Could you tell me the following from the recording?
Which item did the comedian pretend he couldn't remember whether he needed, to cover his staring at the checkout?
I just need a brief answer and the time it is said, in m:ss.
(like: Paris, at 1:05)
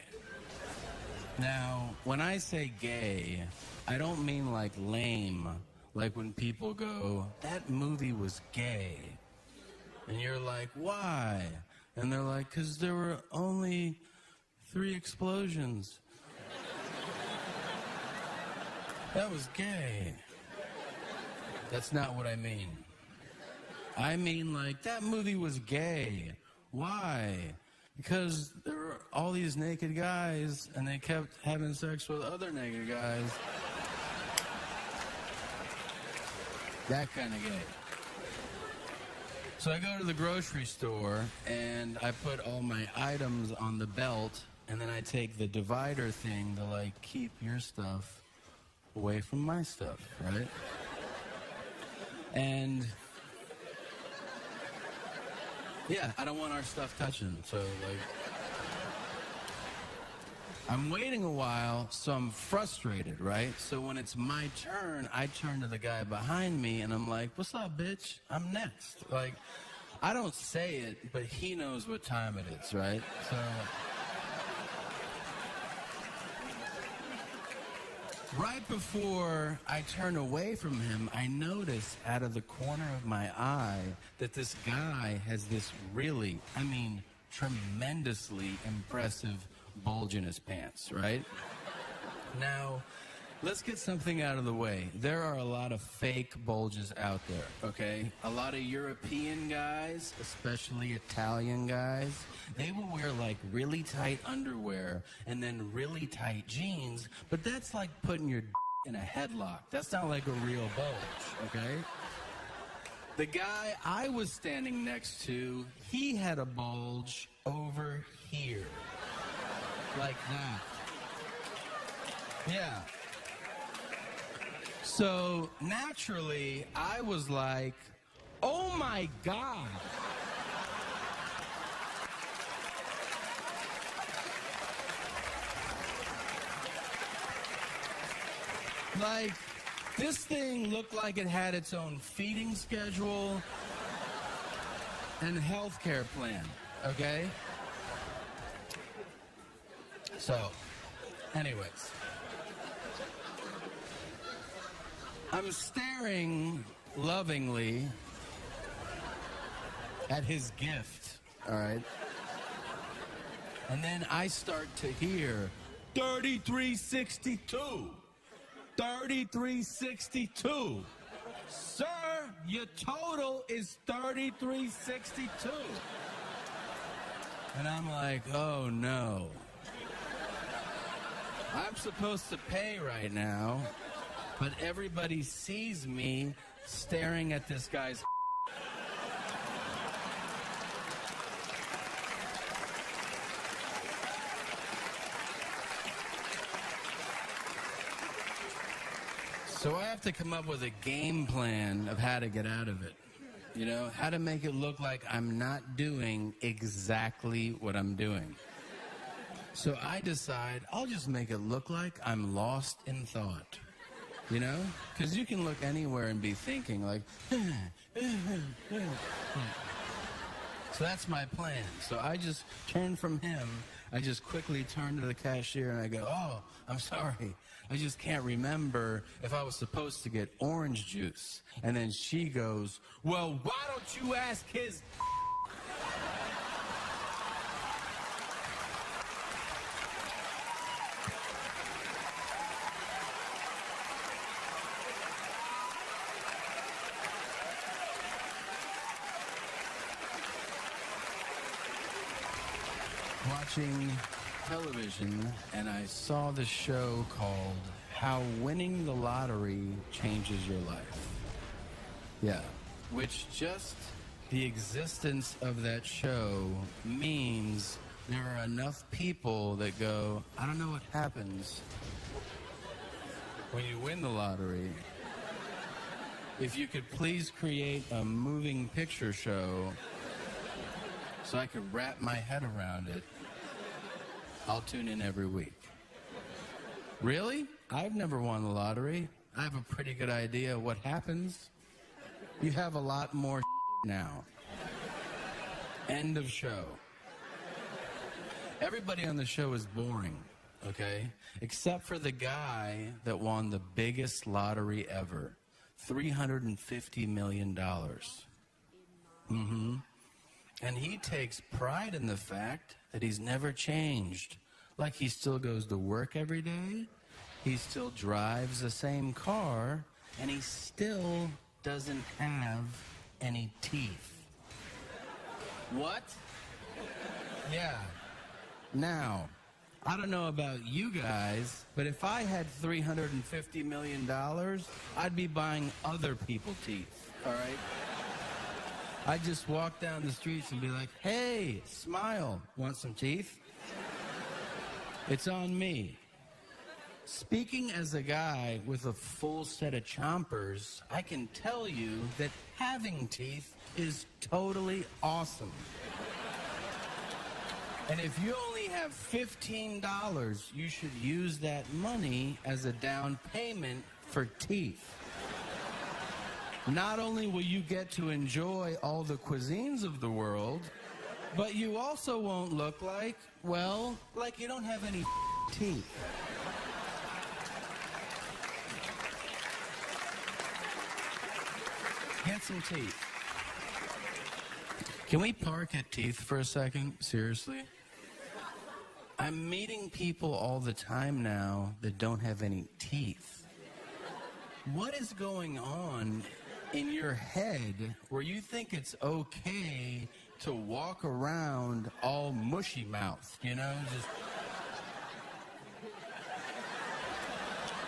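Orange juice, at 3:50.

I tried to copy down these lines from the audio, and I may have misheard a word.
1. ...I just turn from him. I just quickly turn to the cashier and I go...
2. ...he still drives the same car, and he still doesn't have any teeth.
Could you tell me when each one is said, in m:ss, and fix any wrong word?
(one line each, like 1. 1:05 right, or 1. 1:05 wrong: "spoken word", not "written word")
1. 3:42 right
2. 5:17 right.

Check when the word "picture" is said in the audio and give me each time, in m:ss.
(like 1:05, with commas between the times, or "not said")
4:38.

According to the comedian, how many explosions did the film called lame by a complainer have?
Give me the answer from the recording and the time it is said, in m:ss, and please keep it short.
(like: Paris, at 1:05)
3, at 0:14.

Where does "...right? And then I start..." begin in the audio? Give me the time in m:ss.
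2:41.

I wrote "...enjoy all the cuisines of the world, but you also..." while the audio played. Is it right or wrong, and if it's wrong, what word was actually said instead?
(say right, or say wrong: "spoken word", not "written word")
right.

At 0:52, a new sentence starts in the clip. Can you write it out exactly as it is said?
And yeah, I don't want our stuff touching.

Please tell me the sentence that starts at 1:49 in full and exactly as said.
That's not like a real bulge, okay?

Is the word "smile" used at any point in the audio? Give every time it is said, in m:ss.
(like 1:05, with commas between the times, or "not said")
5:41.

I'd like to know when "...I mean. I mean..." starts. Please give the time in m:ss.
0:22.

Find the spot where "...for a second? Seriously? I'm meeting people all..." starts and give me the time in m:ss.
6:26.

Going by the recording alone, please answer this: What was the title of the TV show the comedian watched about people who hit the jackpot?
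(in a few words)
How Winning the Lottery Changes Your Life.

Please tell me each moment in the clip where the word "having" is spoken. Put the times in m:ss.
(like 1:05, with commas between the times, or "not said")
0:31, 5:52.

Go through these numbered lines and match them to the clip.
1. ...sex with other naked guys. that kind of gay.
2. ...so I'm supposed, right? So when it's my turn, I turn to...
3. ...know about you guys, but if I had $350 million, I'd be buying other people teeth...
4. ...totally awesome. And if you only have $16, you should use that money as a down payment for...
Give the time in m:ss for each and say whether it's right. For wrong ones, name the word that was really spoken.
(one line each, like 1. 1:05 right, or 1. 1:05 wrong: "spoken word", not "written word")
1. 0:31 right
2. 1:01 wrong: "frustrated", not "supposed"
3. 5:30 right
4. 5:54 wrong: "15", not "16".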